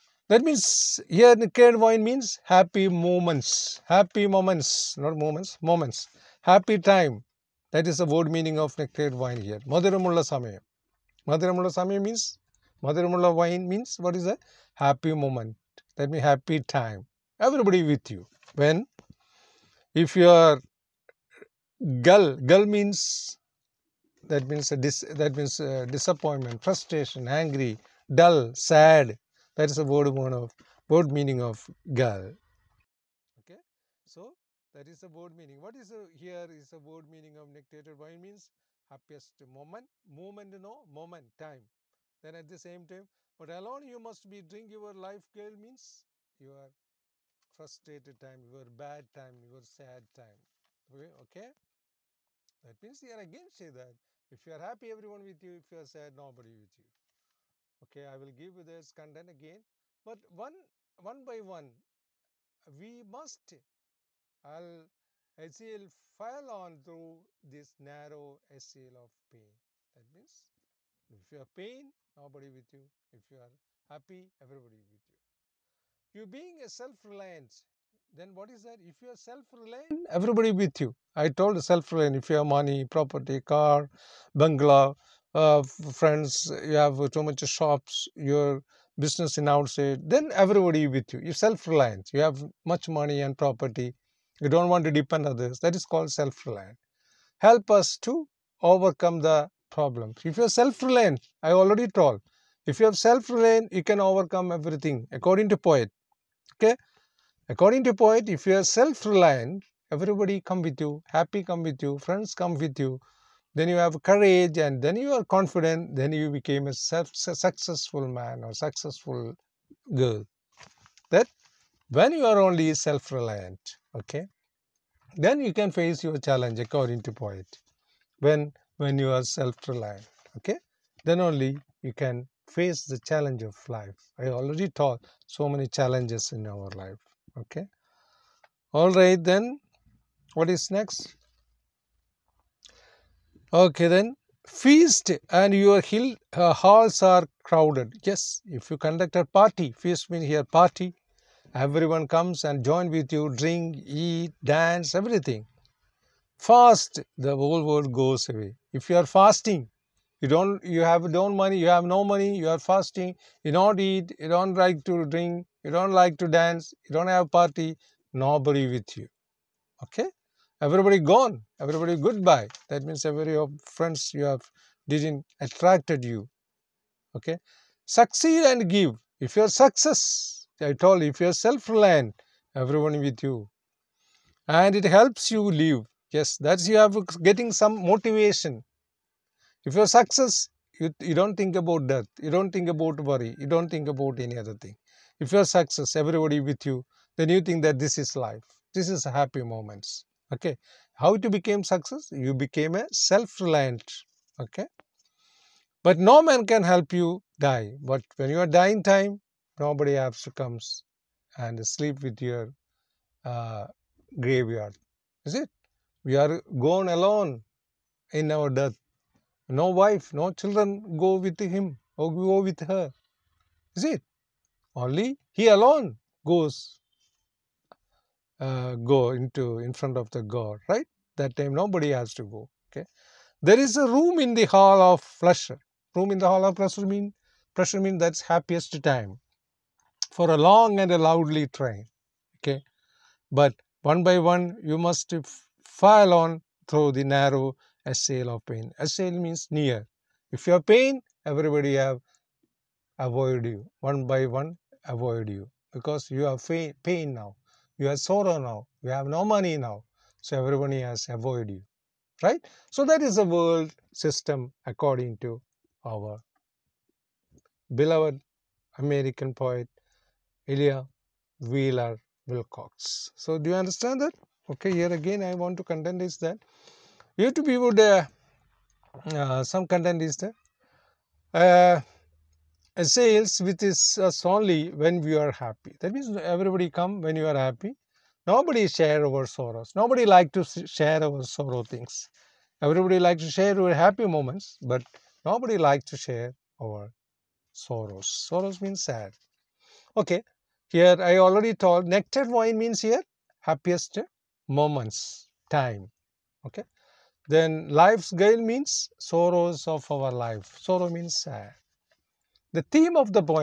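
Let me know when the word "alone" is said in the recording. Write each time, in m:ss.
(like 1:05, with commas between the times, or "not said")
0:43, 3:36, 3:45.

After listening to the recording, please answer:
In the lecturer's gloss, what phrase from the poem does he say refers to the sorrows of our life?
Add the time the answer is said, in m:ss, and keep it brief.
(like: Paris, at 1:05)
life's gale, at 5:07.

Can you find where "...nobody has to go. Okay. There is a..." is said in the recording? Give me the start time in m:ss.
3:51.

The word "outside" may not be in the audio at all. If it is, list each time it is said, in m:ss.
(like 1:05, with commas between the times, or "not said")
1:29.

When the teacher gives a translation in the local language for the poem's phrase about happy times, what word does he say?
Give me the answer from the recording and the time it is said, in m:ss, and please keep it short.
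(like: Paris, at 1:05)
Madhuramulla samayam, at 0:09.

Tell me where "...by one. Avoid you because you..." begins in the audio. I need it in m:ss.
4:14.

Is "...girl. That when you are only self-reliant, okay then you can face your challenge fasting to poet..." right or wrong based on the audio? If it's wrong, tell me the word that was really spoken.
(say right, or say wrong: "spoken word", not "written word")
wrong: "according", not "fasting".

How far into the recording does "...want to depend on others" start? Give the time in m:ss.
1:34.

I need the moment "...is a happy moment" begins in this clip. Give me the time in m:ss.
0:14.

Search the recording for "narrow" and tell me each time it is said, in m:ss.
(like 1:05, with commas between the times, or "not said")
1:07, 4:07.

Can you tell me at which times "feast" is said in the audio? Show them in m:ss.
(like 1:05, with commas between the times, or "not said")
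2:24, 2:29.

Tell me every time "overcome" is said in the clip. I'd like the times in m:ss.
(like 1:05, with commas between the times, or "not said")
1:38, 1:43.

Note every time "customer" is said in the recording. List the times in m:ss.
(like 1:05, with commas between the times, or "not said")
not said.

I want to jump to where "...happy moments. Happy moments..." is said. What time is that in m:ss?
0:02.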